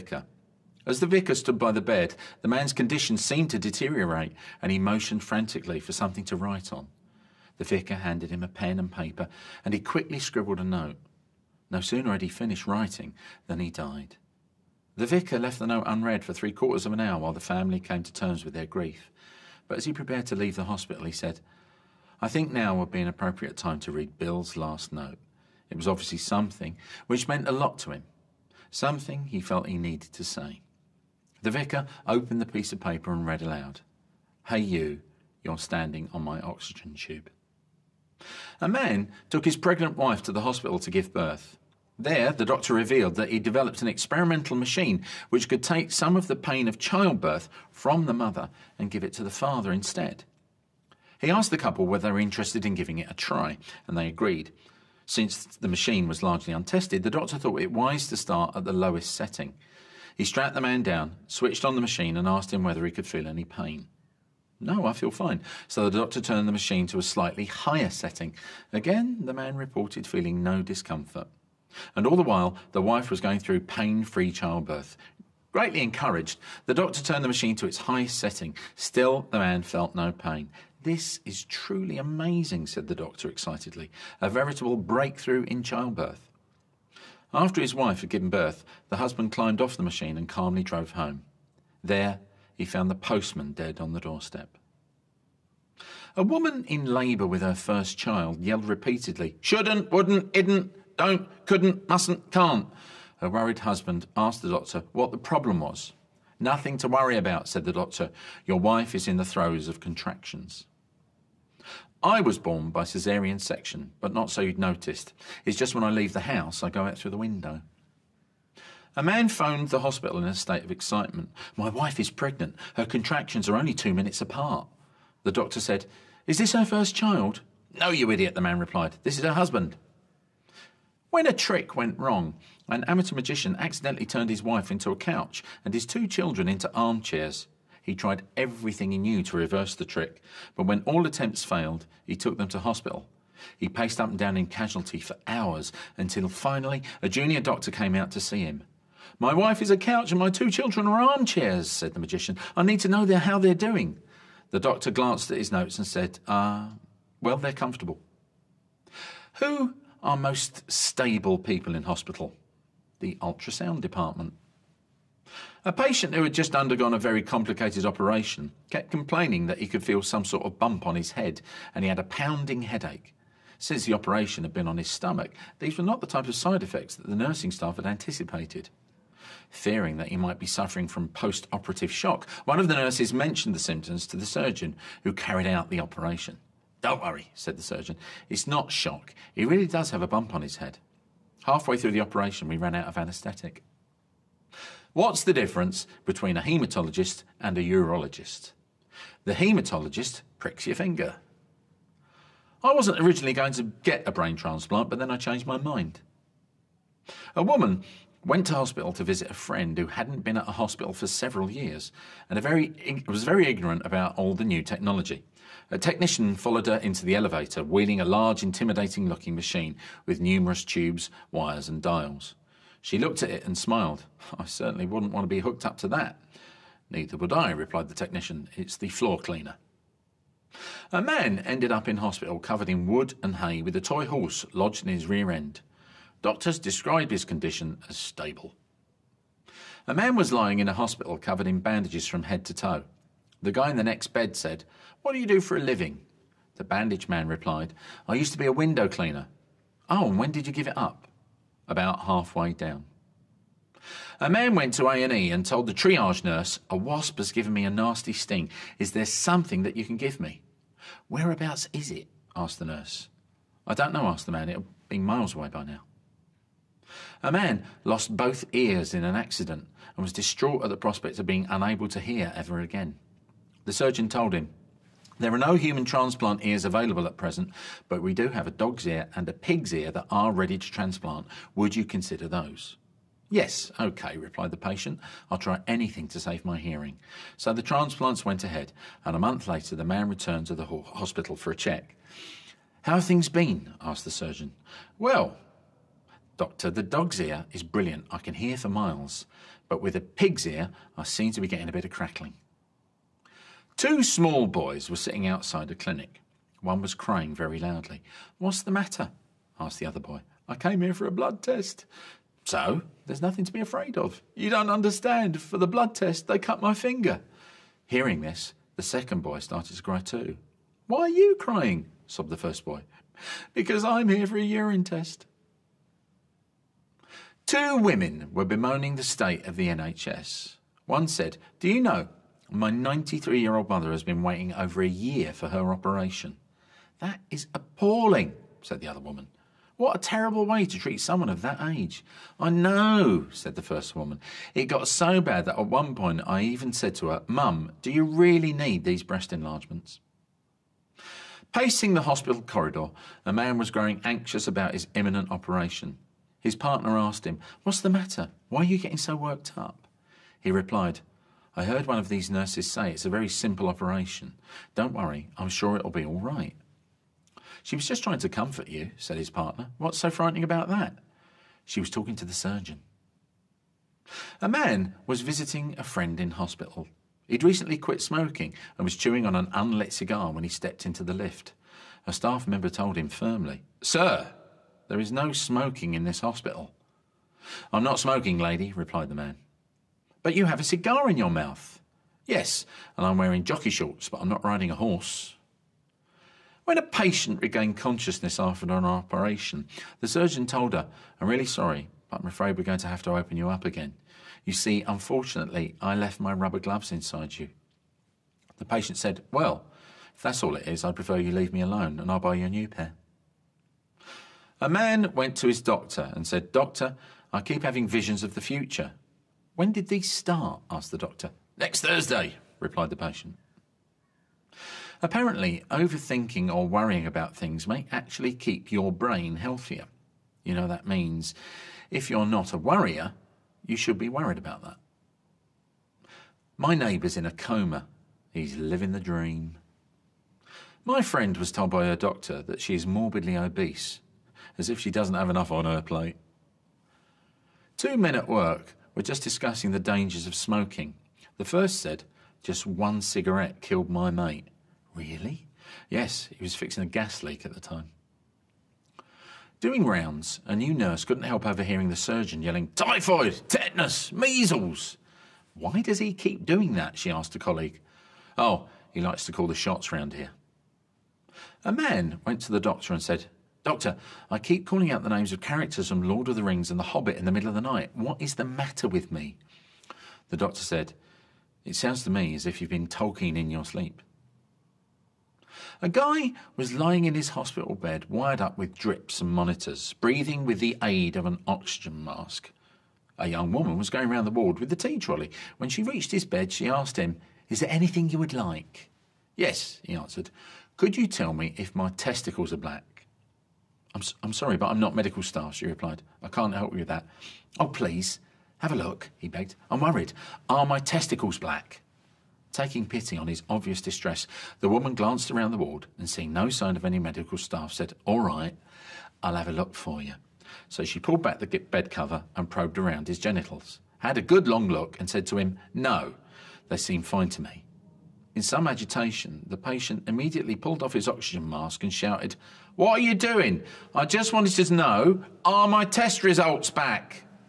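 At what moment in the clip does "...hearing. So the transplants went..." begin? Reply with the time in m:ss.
4:46.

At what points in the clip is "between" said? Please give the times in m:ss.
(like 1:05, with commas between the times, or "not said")
3:16.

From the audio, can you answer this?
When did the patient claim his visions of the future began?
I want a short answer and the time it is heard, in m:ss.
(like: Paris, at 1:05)
Next Thursday, at 7:01.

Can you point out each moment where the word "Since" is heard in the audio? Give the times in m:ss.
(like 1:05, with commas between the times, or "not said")
0:55, 2:53.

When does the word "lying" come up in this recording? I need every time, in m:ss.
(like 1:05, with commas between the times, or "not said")
4:00, 8:06.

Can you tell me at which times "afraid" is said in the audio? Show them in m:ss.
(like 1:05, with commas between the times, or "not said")
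5:13, 6:42.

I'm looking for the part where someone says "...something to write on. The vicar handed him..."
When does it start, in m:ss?
0:05.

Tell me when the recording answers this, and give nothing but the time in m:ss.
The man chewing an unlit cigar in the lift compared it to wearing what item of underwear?
6:33.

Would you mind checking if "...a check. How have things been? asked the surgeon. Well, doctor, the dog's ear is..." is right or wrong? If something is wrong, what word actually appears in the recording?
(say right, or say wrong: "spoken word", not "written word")
right.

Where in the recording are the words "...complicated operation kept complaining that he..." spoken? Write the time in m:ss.
2:47.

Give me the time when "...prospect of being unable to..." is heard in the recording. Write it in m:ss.
4:30.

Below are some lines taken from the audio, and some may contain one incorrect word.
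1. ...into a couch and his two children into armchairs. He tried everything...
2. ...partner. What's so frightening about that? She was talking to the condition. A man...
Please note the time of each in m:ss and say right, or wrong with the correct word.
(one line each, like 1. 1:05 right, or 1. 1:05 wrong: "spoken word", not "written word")
1. 2:14 right
2. 6:09 wrong: "surgeon", not "condition".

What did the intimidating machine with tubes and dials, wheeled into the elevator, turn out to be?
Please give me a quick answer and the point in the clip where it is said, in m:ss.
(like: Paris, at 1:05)
the floor cleaner, at 3:48.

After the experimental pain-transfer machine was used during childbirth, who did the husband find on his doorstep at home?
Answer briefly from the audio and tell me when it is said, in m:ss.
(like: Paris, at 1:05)
the postman, at 1:32.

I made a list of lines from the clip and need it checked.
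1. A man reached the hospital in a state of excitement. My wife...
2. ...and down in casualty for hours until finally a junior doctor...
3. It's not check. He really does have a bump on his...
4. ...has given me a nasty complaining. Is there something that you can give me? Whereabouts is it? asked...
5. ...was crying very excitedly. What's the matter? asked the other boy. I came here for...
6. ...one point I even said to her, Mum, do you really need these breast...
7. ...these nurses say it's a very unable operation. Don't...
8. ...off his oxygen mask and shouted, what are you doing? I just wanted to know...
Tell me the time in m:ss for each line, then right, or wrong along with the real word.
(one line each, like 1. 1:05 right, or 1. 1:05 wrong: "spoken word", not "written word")
1. 1:58 wrong: "phoned", not "reached"
2. 2:24 right
3. 3:08 wrong: "shock", not "check"
4. 4:17 wrong: "sting", not "complaining"
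5. 5:06 wrong: "loudly", not "excitedly"
6. 5:45 right
7. 6:02 wrong: "simple", not "unable"
8. 8:50 right.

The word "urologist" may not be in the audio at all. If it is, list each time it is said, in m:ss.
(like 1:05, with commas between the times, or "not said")
3:17.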